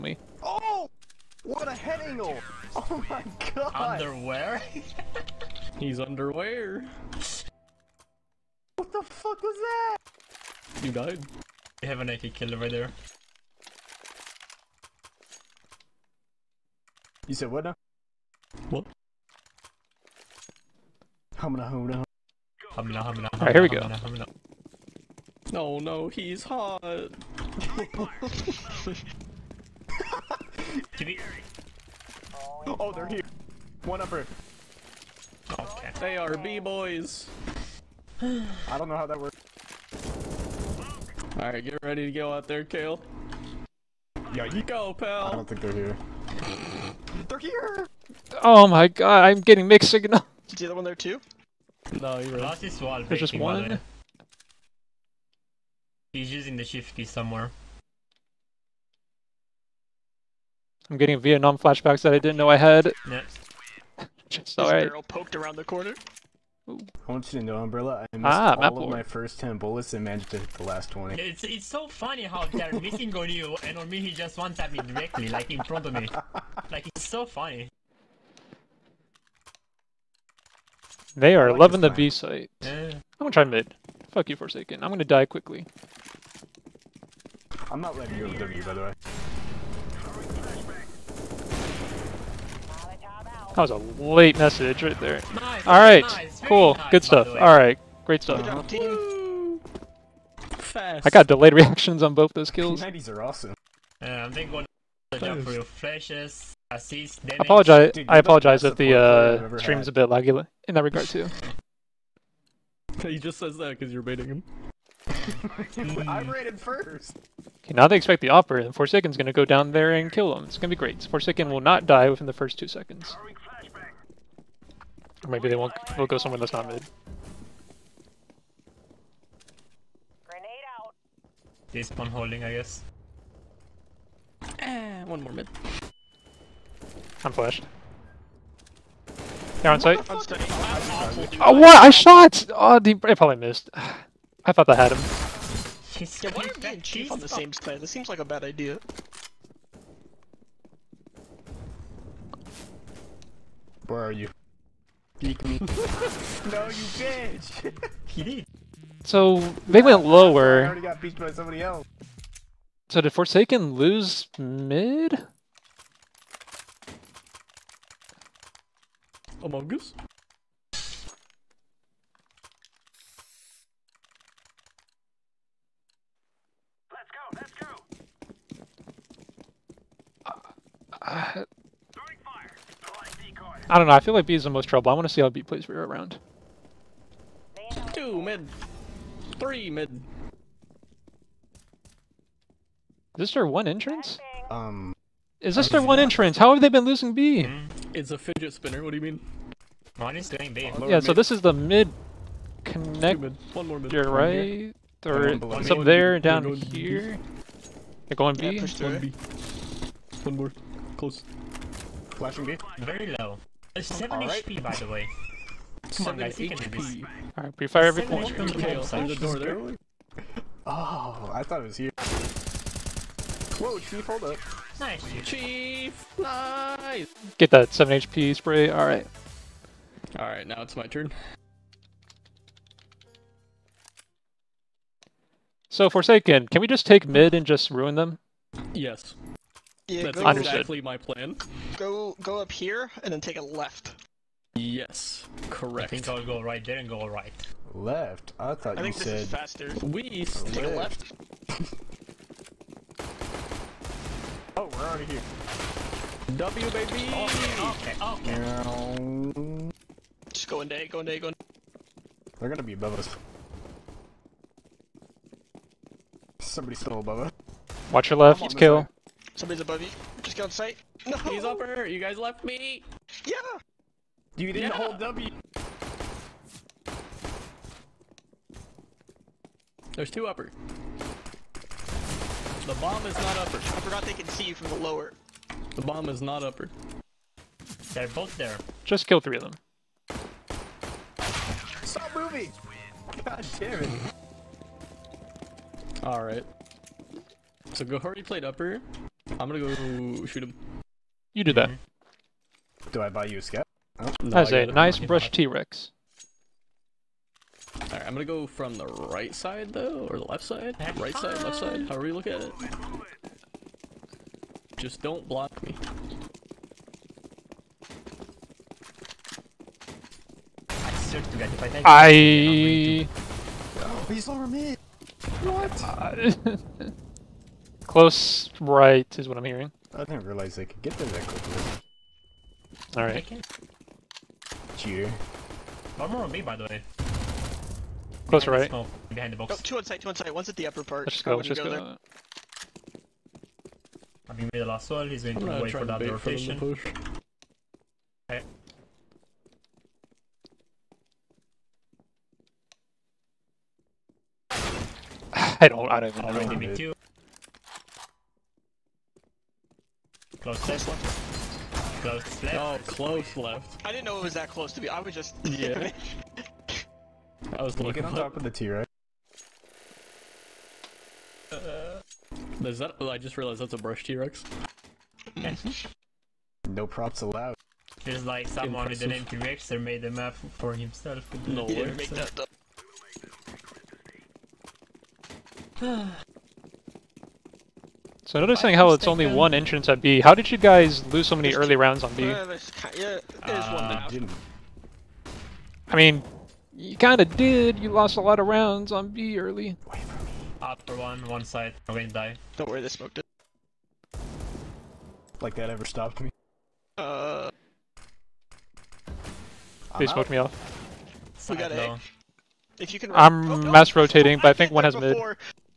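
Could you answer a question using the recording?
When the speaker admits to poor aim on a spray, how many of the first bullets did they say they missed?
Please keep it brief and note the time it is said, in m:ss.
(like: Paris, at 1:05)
10, at 1:09.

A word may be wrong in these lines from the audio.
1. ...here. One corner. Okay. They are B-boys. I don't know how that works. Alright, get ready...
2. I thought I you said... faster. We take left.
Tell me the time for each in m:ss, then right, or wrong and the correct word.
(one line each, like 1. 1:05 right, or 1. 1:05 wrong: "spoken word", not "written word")
1. 0:33 wrong: "upper", not "corner"
2. 4:08 right.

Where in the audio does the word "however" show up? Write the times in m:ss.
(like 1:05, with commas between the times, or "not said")
5:11.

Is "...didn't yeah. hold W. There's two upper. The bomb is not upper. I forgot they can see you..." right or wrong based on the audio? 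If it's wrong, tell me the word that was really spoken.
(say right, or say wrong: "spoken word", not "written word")
right.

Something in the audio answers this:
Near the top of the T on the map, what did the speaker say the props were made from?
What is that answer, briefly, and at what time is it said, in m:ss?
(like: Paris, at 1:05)
Brush T-Rex, at 6:13.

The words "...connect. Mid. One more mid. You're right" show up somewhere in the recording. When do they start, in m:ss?
3:22.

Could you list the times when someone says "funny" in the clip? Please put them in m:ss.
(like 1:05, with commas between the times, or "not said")
1:11, 1:17.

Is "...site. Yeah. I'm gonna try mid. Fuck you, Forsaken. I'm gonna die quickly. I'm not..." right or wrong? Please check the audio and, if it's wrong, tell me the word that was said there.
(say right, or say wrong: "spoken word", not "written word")
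right.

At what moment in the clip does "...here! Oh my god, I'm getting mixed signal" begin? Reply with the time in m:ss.
0:47.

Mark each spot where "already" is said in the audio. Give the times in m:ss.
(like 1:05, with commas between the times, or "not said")
2:40, 4:14, 5:56.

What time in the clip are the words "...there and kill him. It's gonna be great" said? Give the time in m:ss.
1:59.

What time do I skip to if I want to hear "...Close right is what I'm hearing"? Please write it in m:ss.
5:27.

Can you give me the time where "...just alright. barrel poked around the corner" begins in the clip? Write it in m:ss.
1:04.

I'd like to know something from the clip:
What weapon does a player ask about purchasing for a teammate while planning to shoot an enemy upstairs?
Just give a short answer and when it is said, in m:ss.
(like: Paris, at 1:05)
Scout, at 5:03.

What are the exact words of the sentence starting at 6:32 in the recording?
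Uh, I mean, you kinda did, you lost a lot of rounds on B early.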